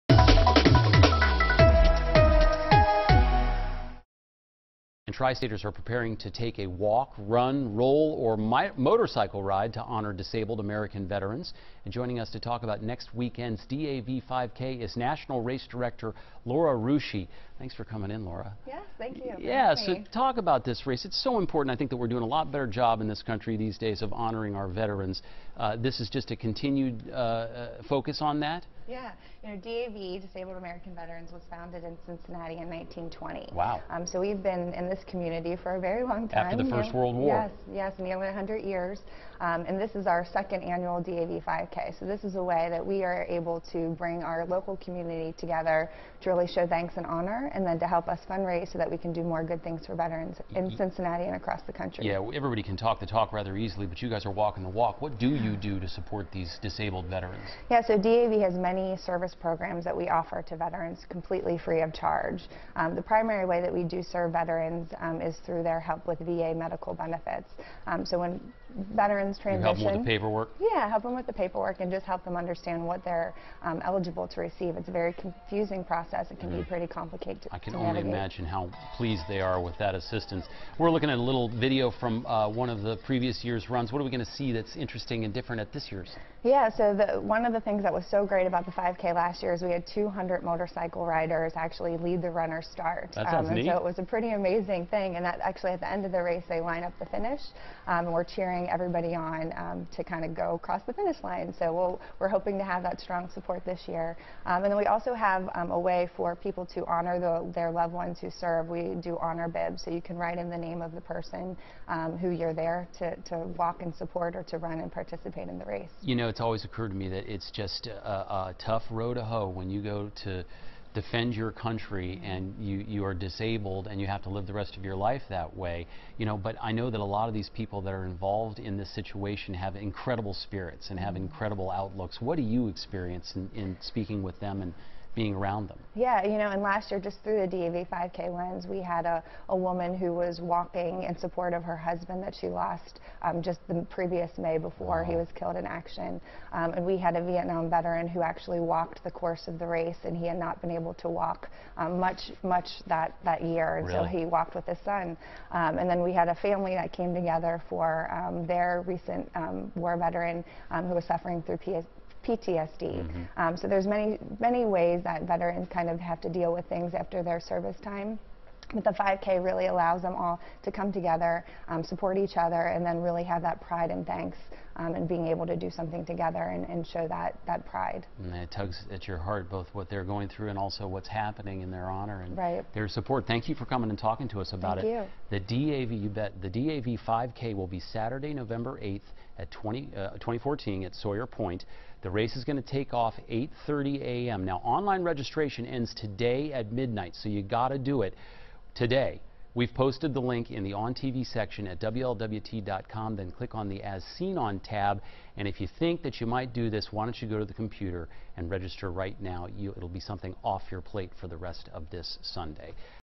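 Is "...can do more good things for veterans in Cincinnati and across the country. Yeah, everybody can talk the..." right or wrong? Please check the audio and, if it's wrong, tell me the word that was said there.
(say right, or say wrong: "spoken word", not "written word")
right.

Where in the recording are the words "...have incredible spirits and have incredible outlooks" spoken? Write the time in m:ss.
2:09.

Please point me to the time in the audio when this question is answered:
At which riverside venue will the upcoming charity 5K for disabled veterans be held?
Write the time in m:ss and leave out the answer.
3:10.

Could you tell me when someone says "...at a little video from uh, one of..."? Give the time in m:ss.
1:21.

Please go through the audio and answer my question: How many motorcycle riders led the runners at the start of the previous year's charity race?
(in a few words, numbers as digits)
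200.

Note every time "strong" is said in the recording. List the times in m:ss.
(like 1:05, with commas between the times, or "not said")
1:43.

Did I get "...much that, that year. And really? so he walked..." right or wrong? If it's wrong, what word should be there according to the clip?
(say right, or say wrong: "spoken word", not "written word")
right.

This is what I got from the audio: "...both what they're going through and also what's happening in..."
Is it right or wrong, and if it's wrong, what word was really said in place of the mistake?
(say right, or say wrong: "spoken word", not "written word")
right.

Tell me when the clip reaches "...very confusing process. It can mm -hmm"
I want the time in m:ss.
1:14.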